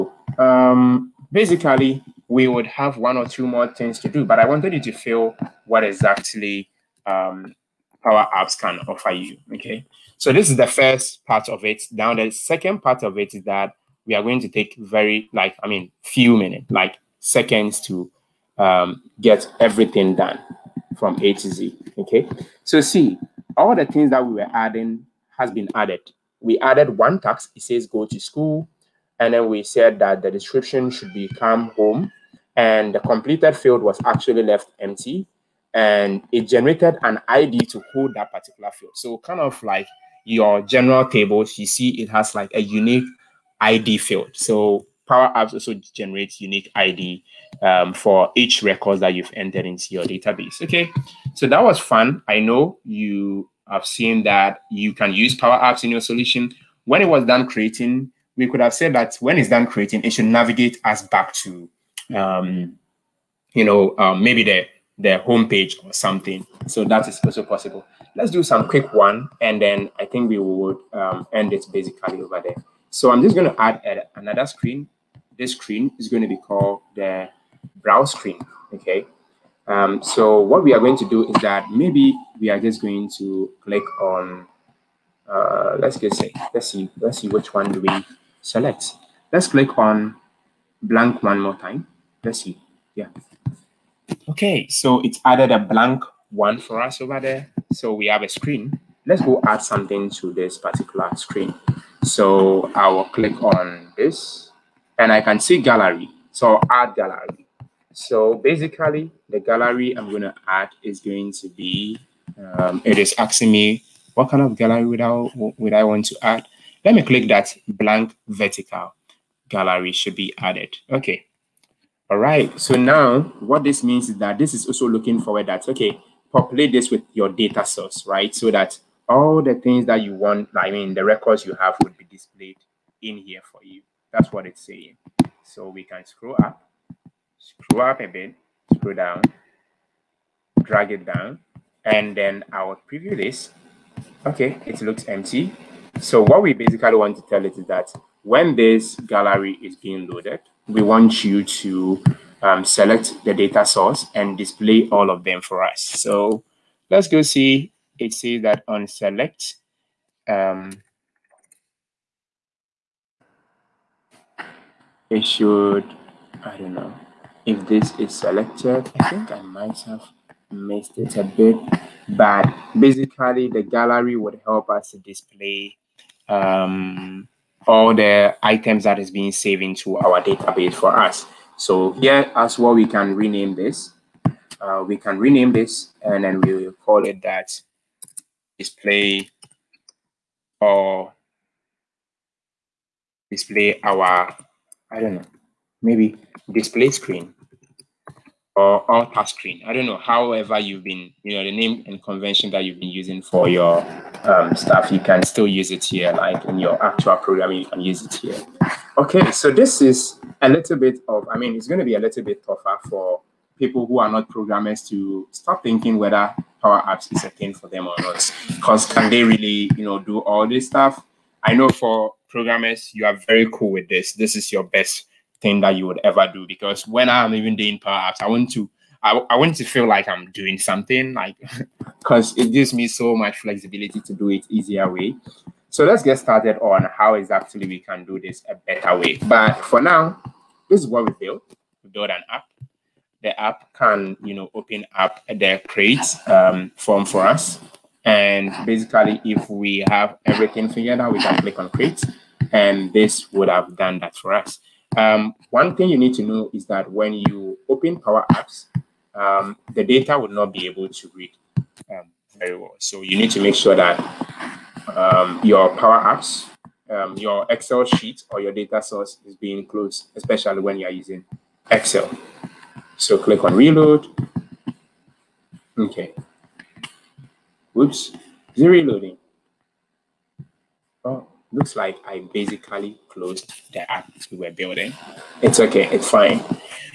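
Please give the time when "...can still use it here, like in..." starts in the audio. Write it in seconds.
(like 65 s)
204 s.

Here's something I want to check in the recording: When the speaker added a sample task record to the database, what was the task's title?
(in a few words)
Go to school.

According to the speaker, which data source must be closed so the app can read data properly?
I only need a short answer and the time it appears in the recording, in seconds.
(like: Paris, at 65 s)
Excel sheet, at 267 s.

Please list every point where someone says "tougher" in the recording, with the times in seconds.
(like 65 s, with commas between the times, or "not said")
212 s.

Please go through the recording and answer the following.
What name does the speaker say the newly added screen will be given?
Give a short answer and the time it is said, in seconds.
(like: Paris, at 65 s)
Browse screen, at 76 s.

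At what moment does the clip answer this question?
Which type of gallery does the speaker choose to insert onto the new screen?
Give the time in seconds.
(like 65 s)
117 s.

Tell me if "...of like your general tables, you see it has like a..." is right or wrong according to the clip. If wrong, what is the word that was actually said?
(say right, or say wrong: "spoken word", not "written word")
right.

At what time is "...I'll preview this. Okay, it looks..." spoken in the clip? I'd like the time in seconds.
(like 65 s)
142 s.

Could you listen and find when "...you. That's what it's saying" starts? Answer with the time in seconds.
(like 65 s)
133 s.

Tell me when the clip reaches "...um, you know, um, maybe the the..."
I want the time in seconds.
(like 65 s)
62 s.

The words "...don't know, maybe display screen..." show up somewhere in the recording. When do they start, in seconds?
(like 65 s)
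194 s.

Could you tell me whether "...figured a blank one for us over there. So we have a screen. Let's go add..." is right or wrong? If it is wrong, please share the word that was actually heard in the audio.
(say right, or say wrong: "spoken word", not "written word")
wrong: "added", not "figured".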